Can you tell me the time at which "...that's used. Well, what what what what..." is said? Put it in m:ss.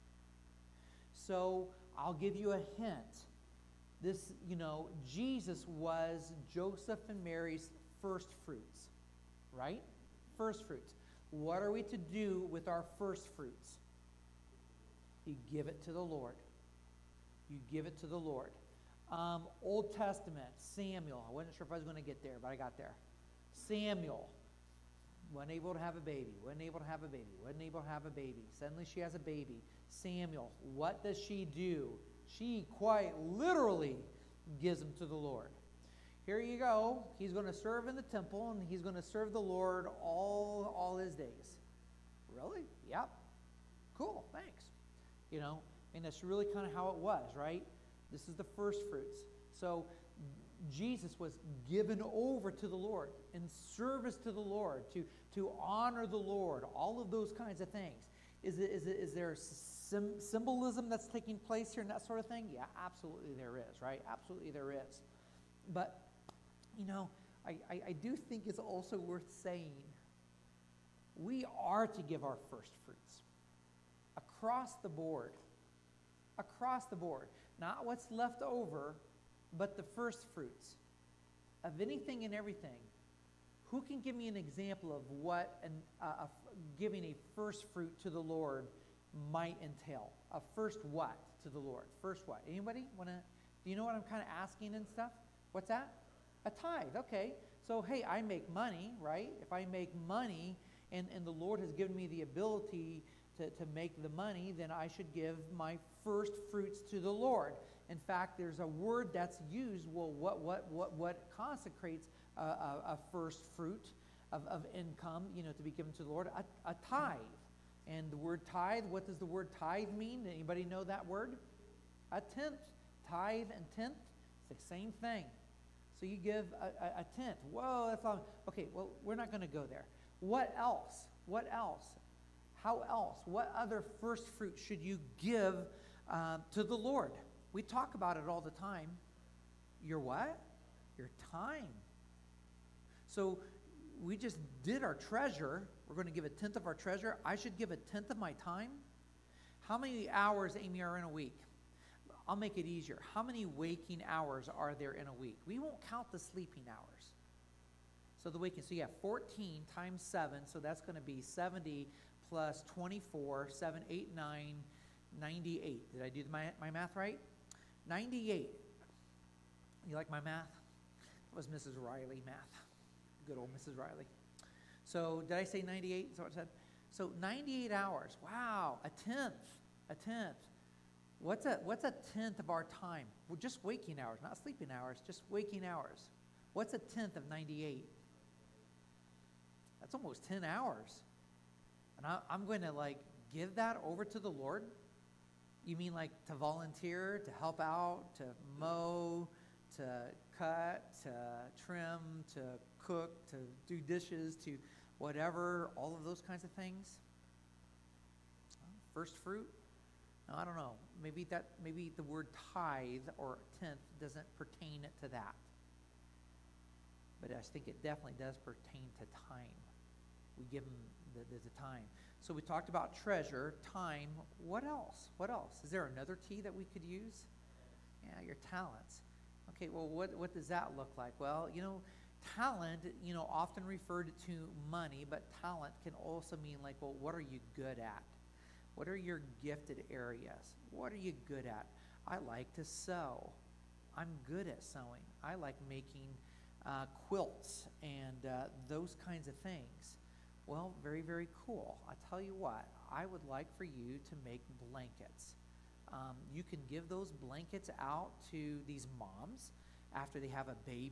1:49.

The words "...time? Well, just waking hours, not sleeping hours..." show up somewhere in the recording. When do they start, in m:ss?
3:02.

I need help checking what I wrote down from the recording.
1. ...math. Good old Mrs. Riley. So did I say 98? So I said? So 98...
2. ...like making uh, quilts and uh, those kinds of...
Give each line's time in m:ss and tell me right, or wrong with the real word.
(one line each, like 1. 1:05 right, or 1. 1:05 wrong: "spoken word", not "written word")
1. 2:52 right
2. 4:05 right.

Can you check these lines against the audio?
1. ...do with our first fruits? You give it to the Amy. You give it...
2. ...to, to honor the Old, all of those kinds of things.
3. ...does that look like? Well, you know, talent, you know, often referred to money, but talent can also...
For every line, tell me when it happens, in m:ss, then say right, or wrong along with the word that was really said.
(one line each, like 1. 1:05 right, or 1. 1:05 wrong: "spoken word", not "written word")
1. 0:11 wrong: "Lord", not "Amy"
2. 0:54 wrong: "Lord", not "Old"
3. 3:50 right.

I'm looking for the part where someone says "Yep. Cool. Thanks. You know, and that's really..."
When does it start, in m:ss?
0:42.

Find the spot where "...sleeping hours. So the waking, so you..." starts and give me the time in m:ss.
2:36.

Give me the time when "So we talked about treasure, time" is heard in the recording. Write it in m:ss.
3:42.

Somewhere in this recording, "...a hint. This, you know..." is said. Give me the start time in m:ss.
0:02.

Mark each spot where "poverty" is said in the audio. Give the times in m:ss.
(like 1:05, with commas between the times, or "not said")
not said.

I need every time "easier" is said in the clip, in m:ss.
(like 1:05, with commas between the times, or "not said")
2:32.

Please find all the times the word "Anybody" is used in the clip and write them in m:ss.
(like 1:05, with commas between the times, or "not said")
1:32, 2:00.